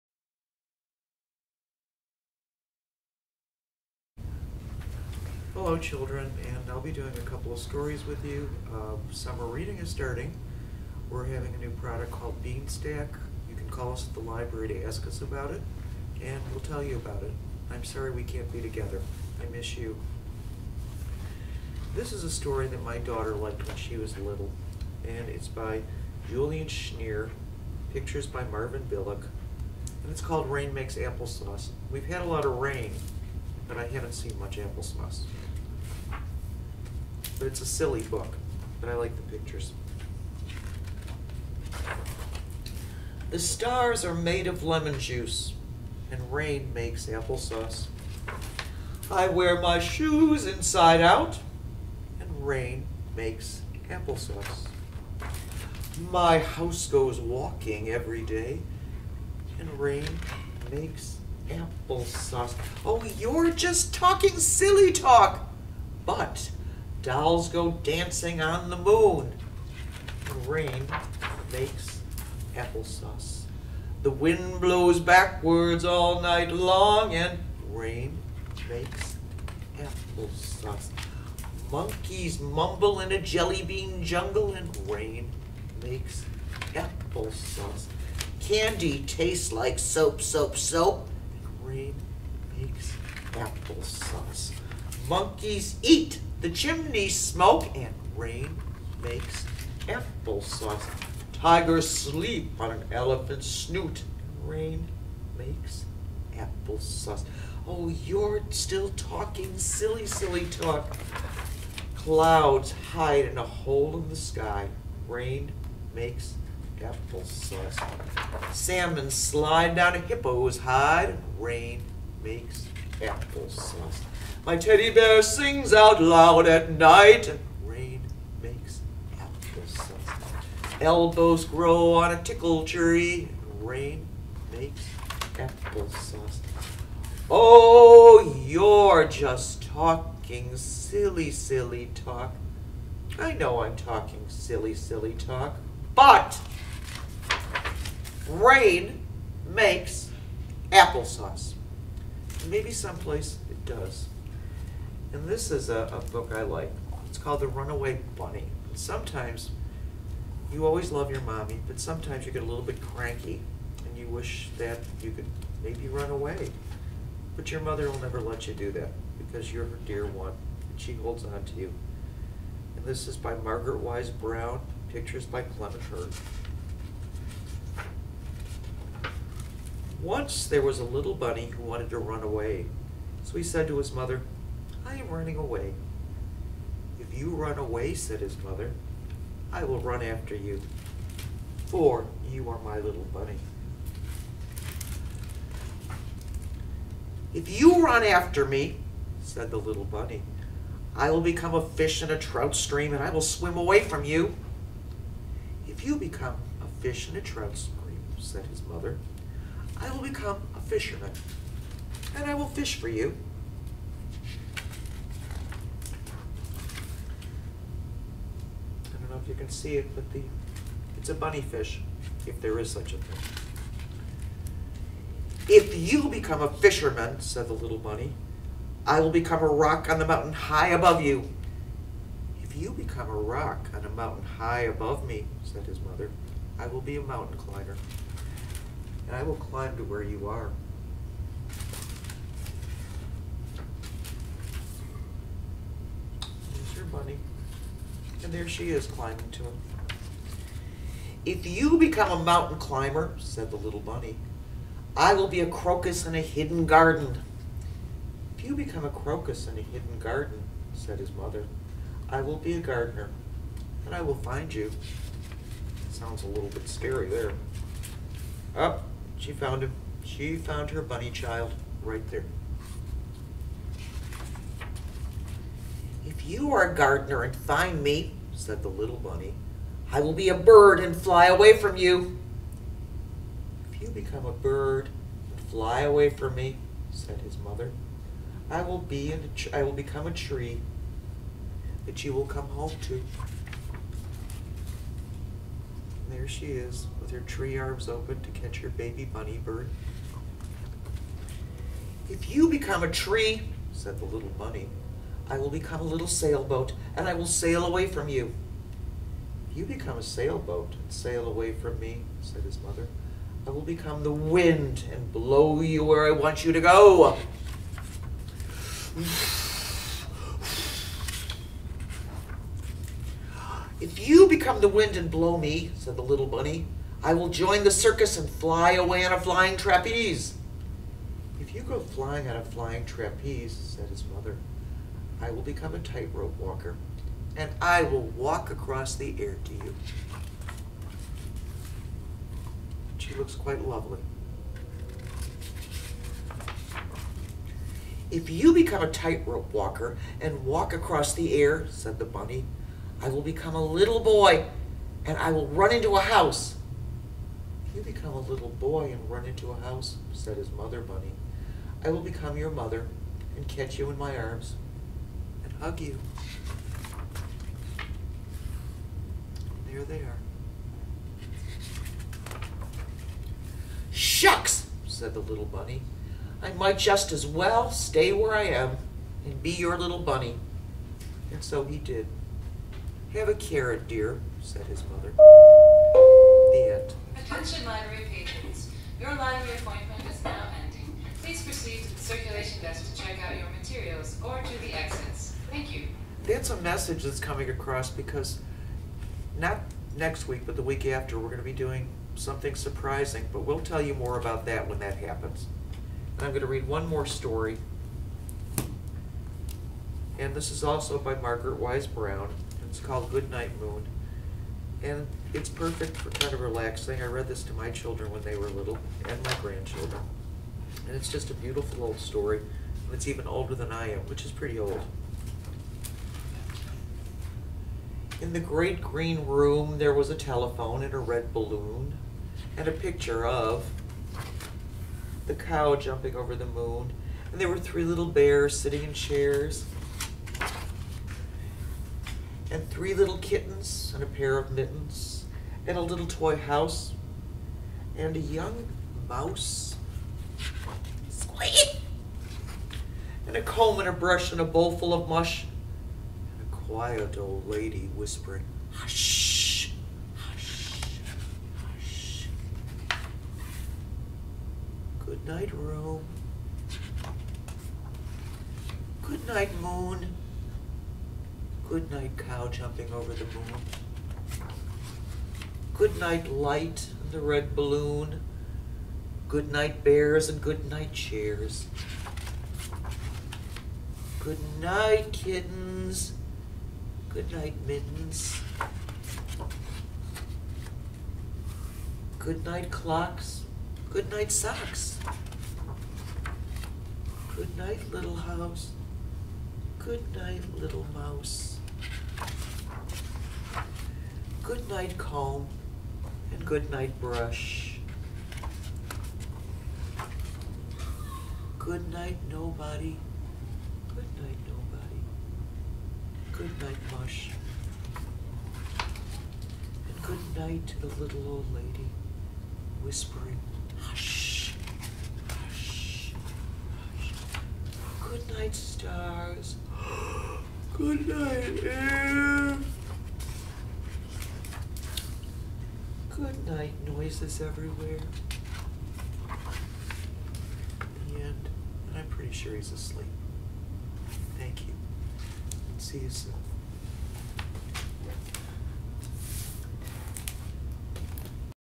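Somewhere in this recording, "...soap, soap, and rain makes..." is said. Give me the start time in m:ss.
1:30.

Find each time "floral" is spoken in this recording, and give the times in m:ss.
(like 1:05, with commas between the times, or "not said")
not said.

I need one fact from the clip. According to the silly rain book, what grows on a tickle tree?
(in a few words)
Elbows.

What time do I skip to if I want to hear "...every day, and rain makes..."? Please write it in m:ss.
0:57.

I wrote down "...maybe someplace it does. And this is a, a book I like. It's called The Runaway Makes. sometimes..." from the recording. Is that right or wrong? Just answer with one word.
wrong.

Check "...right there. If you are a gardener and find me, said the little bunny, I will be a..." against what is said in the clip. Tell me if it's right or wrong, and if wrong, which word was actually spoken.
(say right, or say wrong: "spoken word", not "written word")
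right.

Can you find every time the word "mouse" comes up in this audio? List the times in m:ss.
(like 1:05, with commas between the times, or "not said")
7:29, 8:20.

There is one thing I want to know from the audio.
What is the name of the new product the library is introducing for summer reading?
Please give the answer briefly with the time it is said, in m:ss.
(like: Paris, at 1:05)
Beanstack, at 0:12.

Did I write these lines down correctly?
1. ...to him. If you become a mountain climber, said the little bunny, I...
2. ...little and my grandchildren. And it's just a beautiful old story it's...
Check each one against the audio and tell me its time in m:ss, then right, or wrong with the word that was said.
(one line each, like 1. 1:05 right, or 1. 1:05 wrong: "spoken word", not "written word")
1. 4:09 right
2. 6:58 right.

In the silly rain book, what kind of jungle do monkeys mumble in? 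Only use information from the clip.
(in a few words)
Jelly bean jungle.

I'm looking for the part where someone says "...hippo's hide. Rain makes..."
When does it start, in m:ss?
1:59.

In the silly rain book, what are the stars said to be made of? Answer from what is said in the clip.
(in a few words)
Lemon juice.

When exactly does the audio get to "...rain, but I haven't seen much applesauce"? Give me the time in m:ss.
0:32.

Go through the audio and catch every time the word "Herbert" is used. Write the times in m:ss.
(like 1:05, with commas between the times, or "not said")
not said.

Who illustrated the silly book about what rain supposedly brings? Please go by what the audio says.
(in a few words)
Marvin Bileck.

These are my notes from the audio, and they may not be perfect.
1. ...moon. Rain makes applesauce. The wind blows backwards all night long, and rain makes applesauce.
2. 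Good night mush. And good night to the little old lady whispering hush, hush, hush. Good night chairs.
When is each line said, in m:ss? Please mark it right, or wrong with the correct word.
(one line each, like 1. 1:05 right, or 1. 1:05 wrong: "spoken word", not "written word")
1. 1:08 right
2. 8:36 wrong: "stars", not "chairs".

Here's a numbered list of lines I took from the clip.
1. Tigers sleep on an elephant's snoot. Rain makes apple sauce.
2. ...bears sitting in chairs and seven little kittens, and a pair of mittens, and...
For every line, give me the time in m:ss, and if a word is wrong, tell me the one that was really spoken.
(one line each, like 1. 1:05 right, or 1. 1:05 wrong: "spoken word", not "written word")
1. 1:41 right
2. 7:18 wrong: "three", not "seven".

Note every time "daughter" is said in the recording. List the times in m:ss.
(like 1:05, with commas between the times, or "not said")
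0:22.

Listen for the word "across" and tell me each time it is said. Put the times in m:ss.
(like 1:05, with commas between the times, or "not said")
5:38, 5:50, 6:37.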